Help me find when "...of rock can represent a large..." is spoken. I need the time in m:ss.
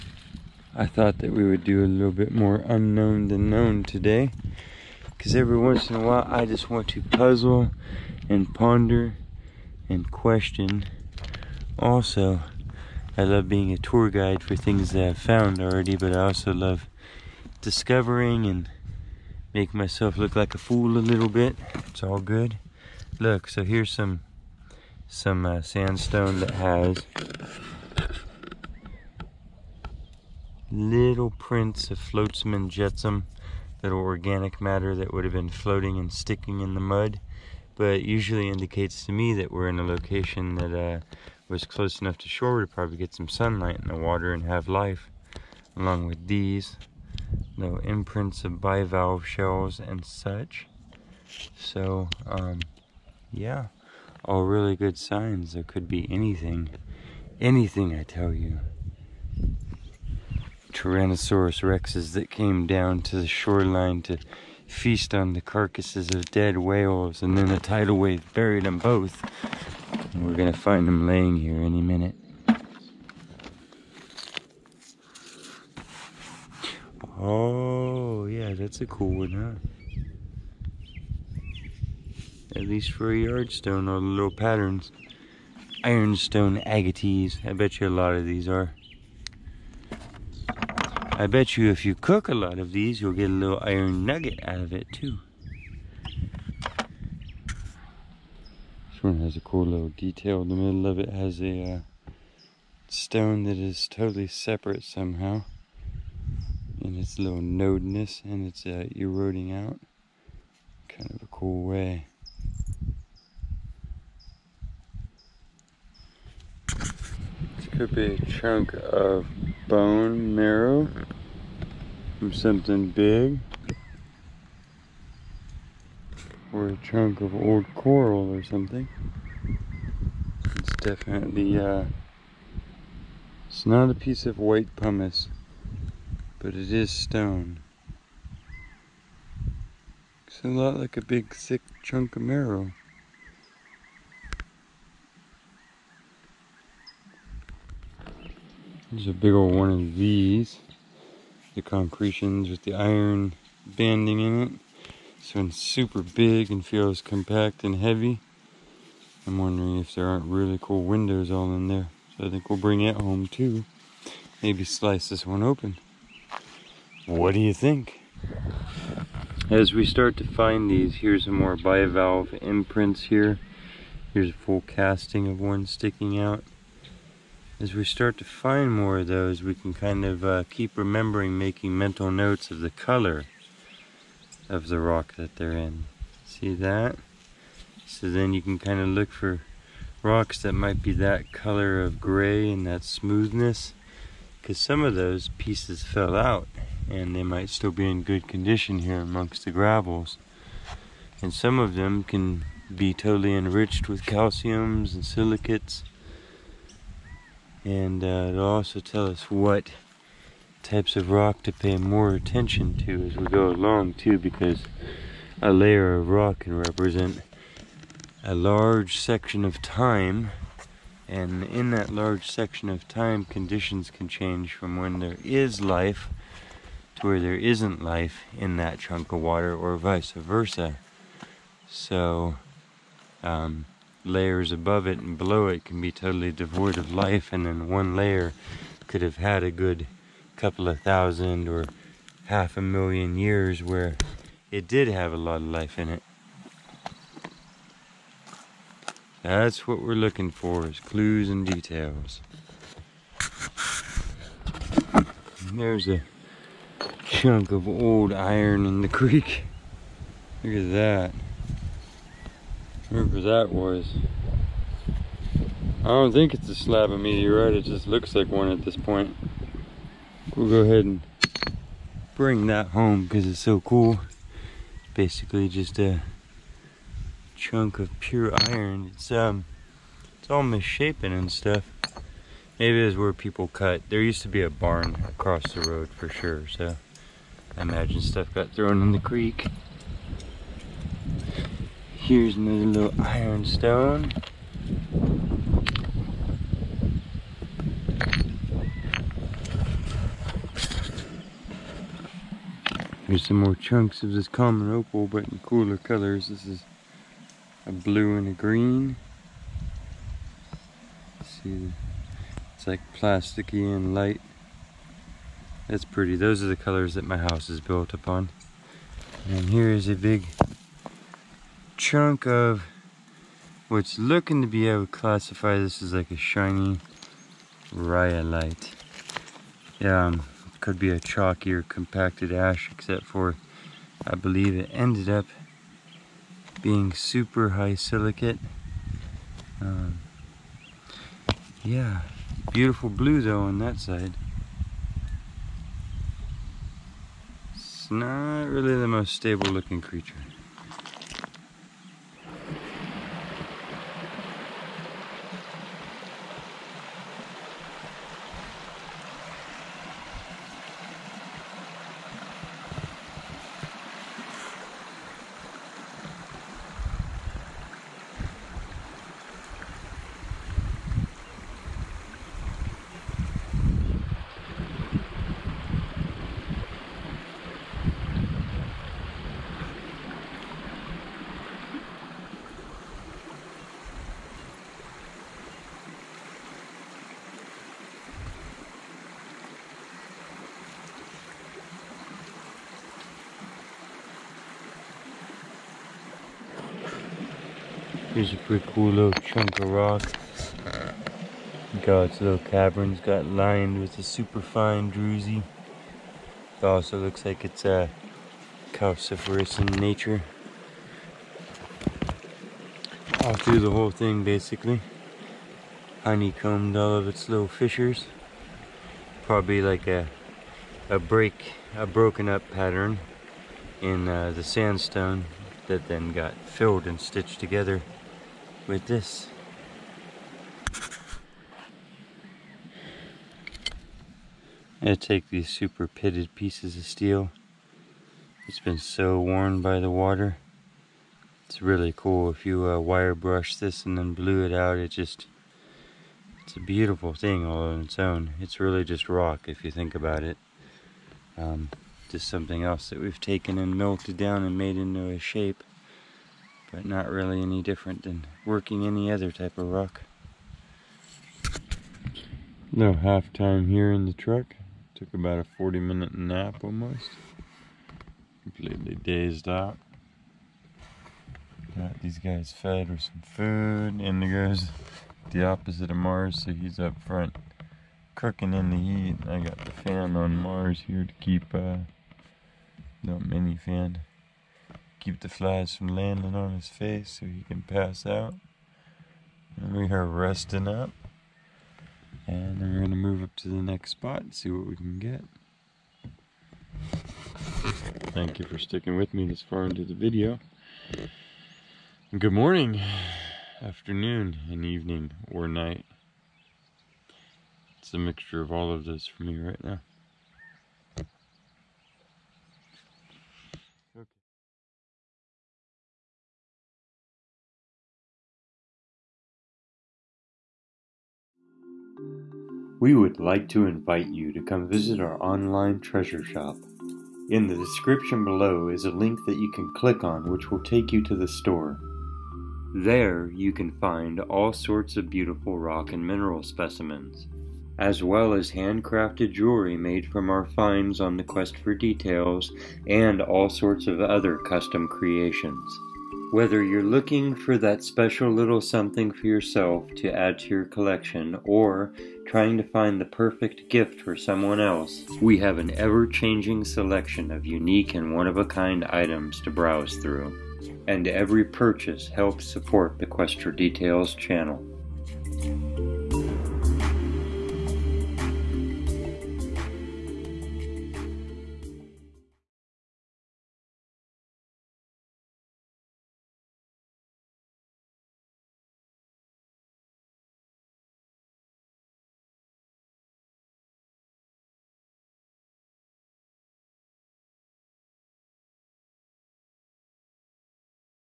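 3:35.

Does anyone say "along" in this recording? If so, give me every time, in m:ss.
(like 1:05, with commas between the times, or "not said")
0:45, 3:33.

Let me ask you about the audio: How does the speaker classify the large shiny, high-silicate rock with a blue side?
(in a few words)
Shiny rhyolite.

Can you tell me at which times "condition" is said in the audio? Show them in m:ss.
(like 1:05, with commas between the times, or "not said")
3:18, 3:43.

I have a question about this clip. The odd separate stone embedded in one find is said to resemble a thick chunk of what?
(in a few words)
Bone marrow.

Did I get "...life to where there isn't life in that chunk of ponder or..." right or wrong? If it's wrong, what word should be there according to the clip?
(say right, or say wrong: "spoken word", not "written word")
wrong: "water", not "ponder".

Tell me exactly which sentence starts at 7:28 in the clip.
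It's really just rock if you think about it.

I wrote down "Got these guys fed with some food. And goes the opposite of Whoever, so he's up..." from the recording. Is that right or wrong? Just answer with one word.
wrong.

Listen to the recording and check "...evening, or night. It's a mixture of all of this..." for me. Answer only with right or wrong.
right.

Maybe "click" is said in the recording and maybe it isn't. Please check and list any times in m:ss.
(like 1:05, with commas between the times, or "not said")
8:49.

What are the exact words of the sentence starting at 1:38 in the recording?
This one has a cool little detail.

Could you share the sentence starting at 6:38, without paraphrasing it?
Here's a pretty cool little chunk of rock.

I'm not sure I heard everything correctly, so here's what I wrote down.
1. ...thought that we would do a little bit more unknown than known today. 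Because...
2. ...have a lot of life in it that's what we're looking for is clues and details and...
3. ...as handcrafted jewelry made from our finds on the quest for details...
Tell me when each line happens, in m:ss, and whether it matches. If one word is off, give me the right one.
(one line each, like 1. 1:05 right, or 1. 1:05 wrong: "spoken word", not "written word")
1. 0:00 right
2. 4:04 right
3. 8:58 right.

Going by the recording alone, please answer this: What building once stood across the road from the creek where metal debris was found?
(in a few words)
A barn.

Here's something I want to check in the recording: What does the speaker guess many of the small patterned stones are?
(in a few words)
Ironstone agates.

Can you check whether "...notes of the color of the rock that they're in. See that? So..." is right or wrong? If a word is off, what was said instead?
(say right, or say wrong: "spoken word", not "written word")
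right.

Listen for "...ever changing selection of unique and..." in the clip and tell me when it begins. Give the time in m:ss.
9:15.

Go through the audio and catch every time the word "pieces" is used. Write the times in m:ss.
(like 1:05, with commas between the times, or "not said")
2:13, 3:15, 7:16.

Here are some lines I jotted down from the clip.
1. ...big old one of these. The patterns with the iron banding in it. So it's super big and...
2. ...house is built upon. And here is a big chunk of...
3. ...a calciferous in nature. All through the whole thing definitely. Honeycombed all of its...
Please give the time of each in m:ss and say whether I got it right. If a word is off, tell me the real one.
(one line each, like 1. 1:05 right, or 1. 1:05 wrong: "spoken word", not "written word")
1. 2:29 wrong: "concretions", not "patterns"
2. 5:17 right
3. 6:47 wrong: "basically", not "definitely".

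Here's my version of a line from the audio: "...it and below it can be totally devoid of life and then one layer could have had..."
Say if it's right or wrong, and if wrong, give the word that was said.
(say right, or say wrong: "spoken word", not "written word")
right.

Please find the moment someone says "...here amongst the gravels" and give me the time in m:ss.
3:18.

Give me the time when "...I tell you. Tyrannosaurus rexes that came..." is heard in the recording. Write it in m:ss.
0:57.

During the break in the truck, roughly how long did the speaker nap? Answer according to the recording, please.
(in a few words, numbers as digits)
40 minutes.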